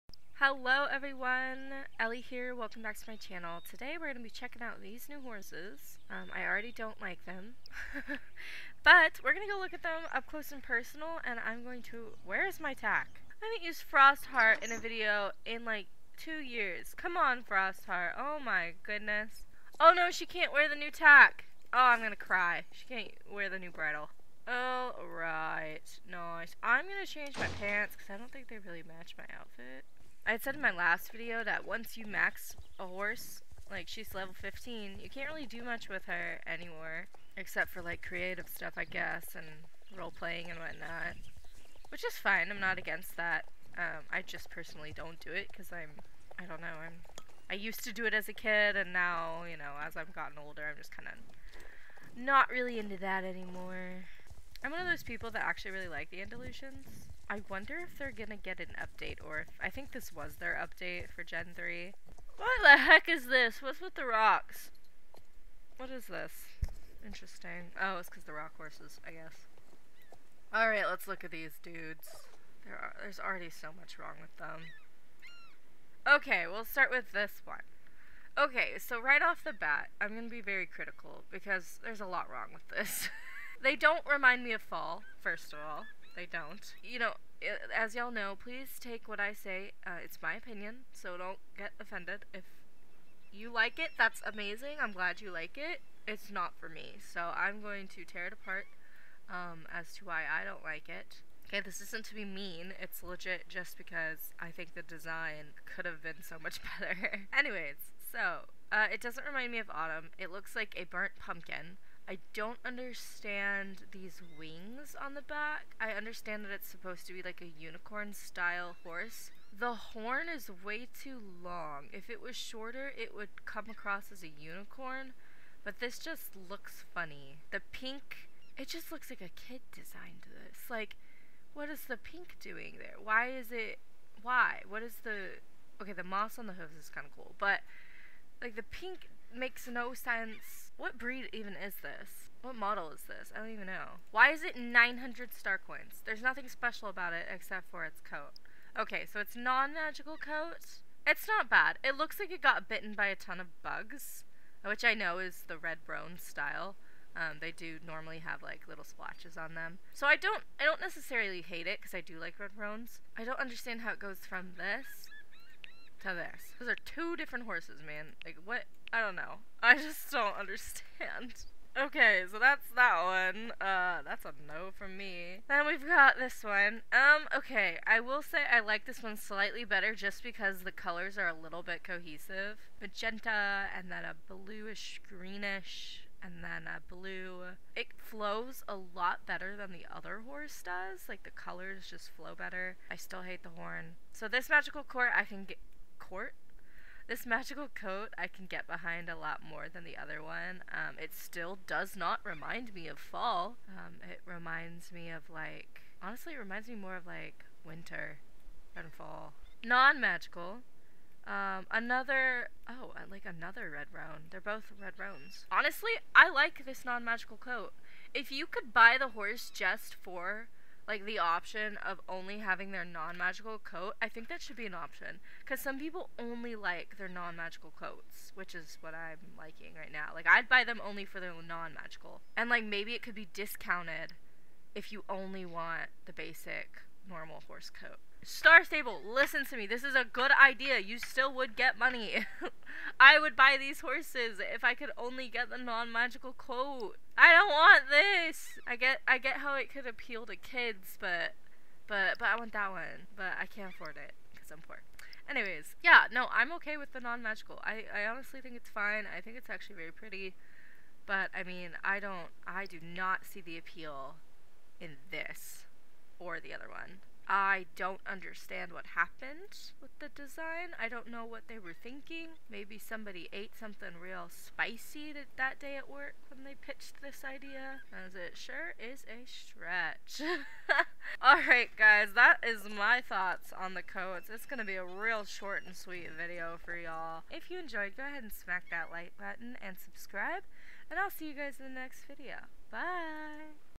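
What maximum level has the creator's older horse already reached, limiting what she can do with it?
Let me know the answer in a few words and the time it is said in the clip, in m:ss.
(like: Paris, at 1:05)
15, at 0:34.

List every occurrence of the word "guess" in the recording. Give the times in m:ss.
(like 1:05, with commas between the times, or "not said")
0:38, 1:09.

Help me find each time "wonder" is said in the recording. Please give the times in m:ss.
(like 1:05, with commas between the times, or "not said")
0:57.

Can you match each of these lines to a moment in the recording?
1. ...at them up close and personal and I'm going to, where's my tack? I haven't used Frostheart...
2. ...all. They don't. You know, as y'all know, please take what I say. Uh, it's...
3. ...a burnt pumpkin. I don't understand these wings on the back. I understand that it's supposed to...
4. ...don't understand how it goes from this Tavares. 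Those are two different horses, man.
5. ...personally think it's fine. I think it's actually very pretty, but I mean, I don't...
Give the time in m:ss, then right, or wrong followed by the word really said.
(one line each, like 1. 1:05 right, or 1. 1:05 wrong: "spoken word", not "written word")
1. 0:09 right
2. 1:25 right
3. 1:50 right
4. 2:43 right
5. 4:18 wrong: "honestly", not "personally".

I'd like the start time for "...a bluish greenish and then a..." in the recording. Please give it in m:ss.
3:04.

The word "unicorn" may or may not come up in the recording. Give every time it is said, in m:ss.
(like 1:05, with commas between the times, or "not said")
1:57, 2:04.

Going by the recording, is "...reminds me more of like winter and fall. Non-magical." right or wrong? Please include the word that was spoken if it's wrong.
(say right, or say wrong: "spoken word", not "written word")
right.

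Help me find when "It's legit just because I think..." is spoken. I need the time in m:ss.
1:42.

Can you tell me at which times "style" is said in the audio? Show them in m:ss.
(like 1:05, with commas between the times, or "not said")
1:58, 2:36.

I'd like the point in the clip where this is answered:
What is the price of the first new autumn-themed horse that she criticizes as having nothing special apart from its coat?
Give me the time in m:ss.
2:24.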